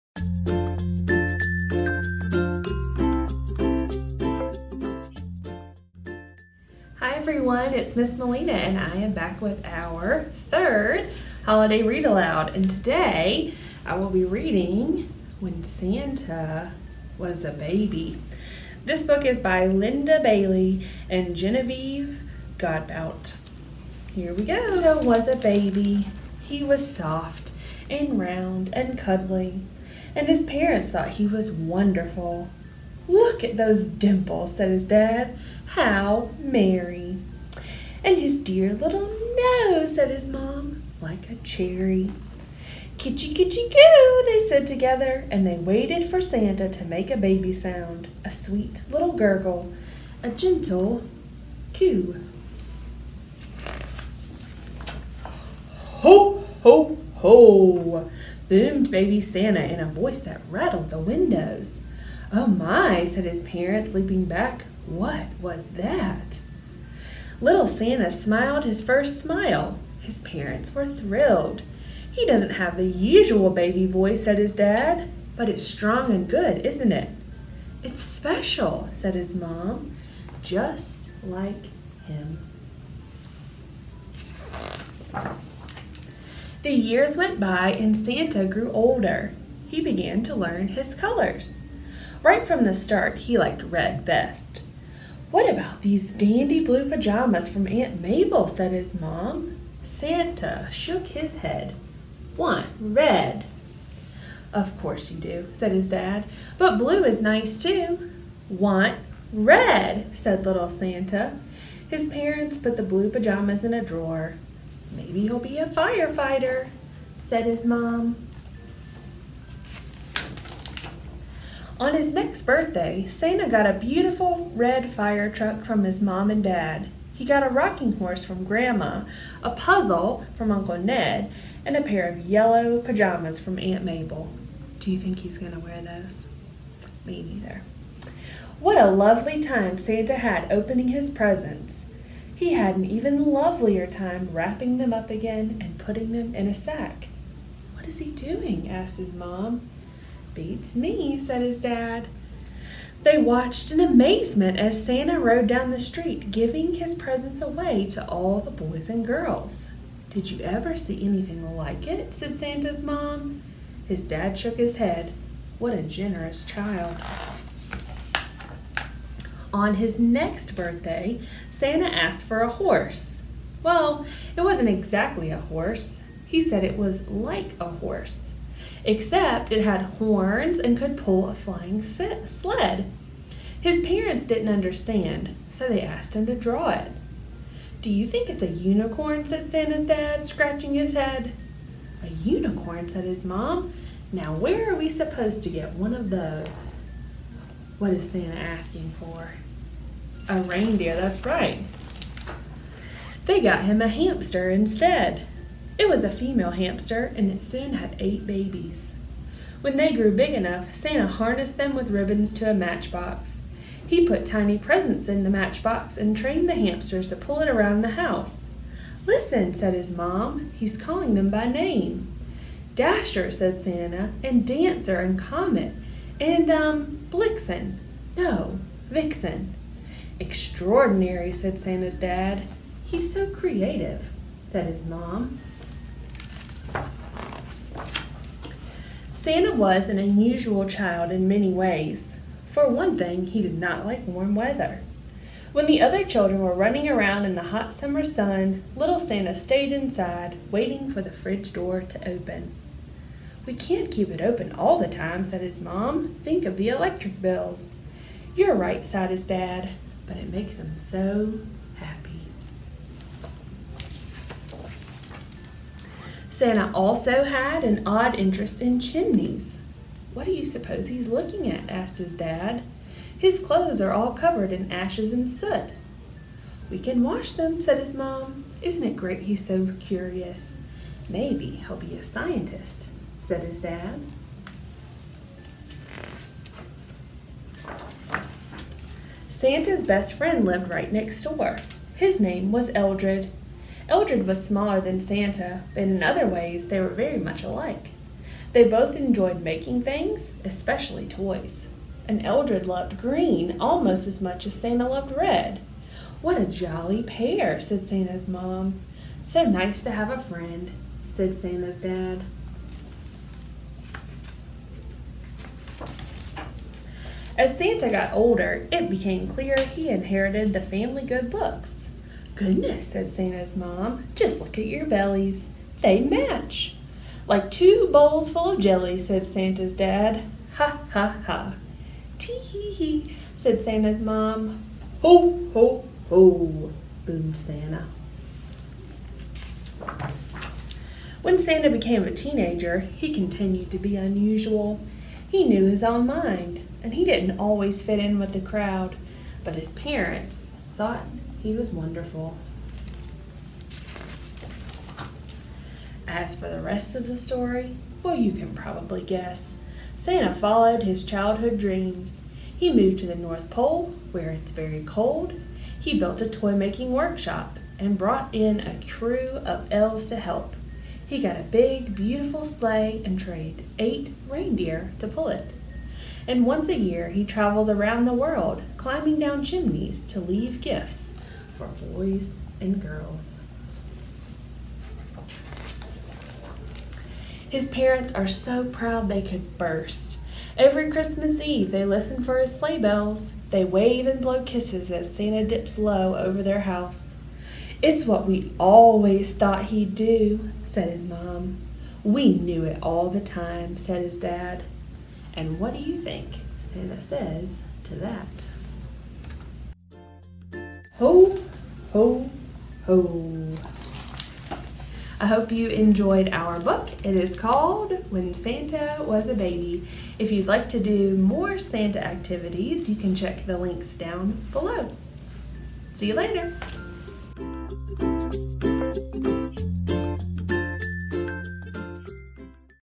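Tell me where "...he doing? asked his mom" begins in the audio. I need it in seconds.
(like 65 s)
147 s.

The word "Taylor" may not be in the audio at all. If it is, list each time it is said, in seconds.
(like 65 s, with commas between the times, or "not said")
not said.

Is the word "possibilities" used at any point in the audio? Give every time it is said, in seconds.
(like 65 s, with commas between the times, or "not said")
not said.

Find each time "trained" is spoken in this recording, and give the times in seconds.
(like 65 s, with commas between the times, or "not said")
216 s, 373 s.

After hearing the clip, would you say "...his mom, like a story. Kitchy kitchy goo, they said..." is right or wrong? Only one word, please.
wrong.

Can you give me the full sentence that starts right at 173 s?
Well, it wasn't exactly a horse.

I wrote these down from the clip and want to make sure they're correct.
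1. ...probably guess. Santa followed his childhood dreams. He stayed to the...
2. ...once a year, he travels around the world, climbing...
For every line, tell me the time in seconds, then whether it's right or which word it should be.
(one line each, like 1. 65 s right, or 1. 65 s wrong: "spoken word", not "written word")
1. 358 s wrong: "moved", not "stayed"
2. 376 s right.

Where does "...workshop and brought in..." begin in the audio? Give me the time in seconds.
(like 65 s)
366 s.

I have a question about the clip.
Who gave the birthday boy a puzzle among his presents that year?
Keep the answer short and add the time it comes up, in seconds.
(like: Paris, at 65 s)
Uncle Ned, at 130 s.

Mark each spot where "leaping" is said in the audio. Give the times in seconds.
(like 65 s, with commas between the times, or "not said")
63 s.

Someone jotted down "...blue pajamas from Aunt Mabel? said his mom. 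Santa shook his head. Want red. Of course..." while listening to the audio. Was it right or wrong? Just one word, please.
right.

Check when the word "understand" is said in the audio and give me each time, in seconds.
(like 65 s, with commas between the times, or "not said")
184 s.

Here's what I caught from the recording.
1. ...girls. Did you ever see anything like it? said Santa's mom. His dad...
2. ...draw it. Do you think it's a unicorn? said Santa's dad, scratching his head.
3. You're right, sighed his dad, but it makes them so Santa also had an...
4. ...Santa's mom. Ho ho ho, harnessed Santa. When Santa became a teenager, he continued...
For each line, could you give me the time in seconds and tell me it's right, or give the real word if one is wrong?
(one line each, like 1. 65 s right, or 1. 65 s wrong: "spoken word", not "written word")
1. 159 s right
2. 186 s right
3. 258 s right
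4. 333 s wrong: "boomed", not "harnessed".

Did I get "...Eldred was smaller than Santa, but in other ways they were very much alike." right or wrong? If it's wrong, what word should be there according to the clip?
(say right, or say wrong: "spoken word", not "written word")
right.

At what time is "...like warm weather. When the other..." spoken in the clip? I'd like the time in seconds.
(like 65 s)
243 s.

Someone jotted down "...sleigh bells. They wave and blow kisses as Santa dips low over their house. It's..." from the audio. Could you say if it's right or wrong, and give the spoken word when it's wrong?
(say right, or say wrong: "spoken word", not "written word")
right.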